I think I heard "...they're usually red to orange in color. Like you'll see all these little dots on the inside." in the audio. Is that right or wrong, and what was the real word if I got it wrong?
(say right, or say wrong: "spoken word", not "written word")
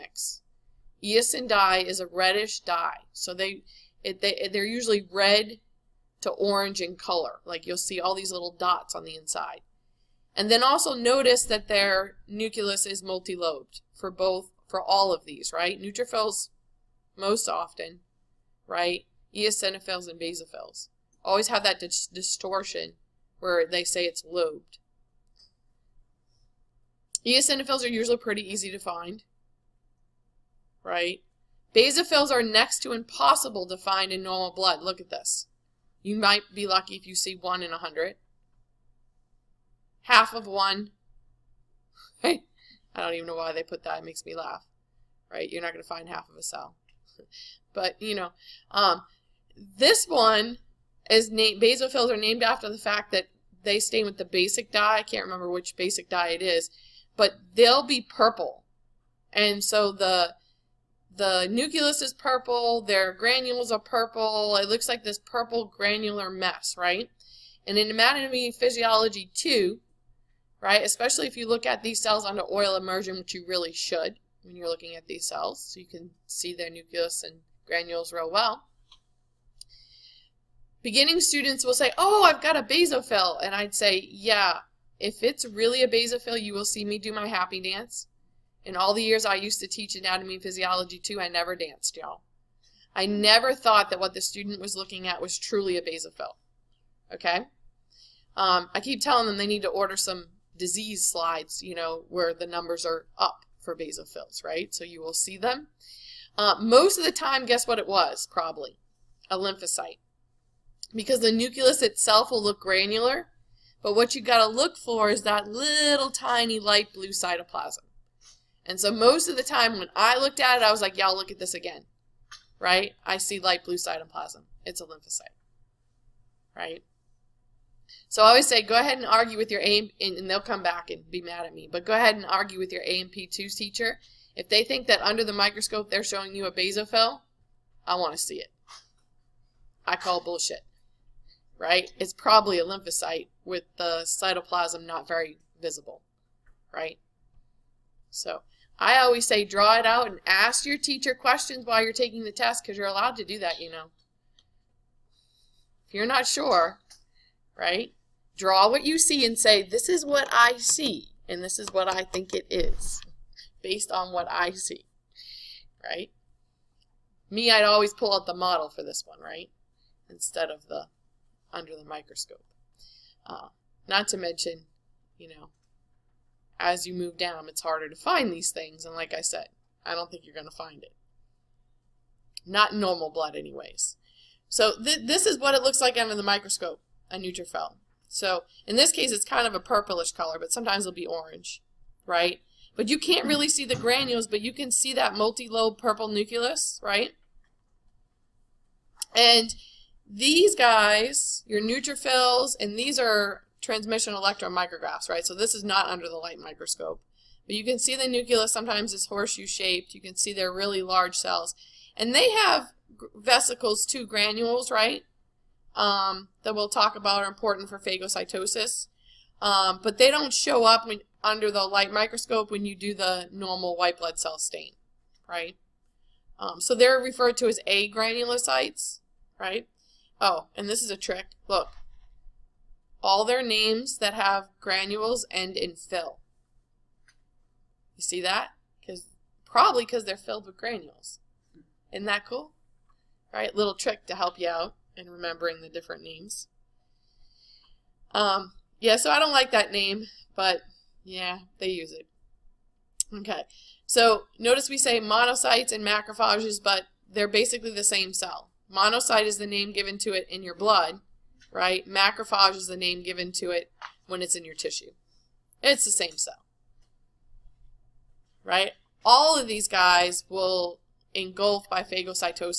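right.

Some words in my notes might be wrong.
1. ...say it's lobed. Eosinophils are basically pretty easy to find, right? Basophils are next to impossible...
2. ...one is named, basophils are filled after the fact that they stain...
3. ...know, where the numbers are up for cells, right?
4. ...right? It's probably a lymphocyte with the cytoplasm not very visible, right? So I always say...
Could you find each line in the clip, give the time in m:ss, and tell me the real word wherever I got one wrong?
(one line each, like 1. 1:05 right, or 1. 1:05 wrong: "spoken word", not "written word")
1. 0:23 wrong: "usually", not "basically"
2. 0:50 wrong: "named", not "filled"
3. 1:41 wrong: "basophils", not "cells"
4. 2:21 right.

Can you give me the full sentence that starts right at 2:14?
If they think that under the microscope they're showing you a basophil, I want to see it.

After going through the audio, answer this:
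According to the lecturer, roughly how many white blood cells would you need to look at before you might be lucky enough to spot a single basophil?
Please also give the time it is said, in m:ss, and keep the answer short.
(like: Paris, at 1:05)
100, at 0:37.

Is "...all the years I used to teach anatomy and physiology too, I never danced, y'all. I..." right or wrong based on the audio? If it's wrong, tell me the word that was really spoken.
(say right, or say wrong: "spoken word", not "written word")
right.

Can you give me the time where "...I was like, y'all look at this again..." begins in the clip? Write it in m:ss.
2:00.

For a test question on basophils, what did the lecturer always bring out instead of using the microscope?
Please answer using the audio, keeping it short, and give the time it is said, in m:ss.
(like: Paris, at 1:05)
The model, at 2:48.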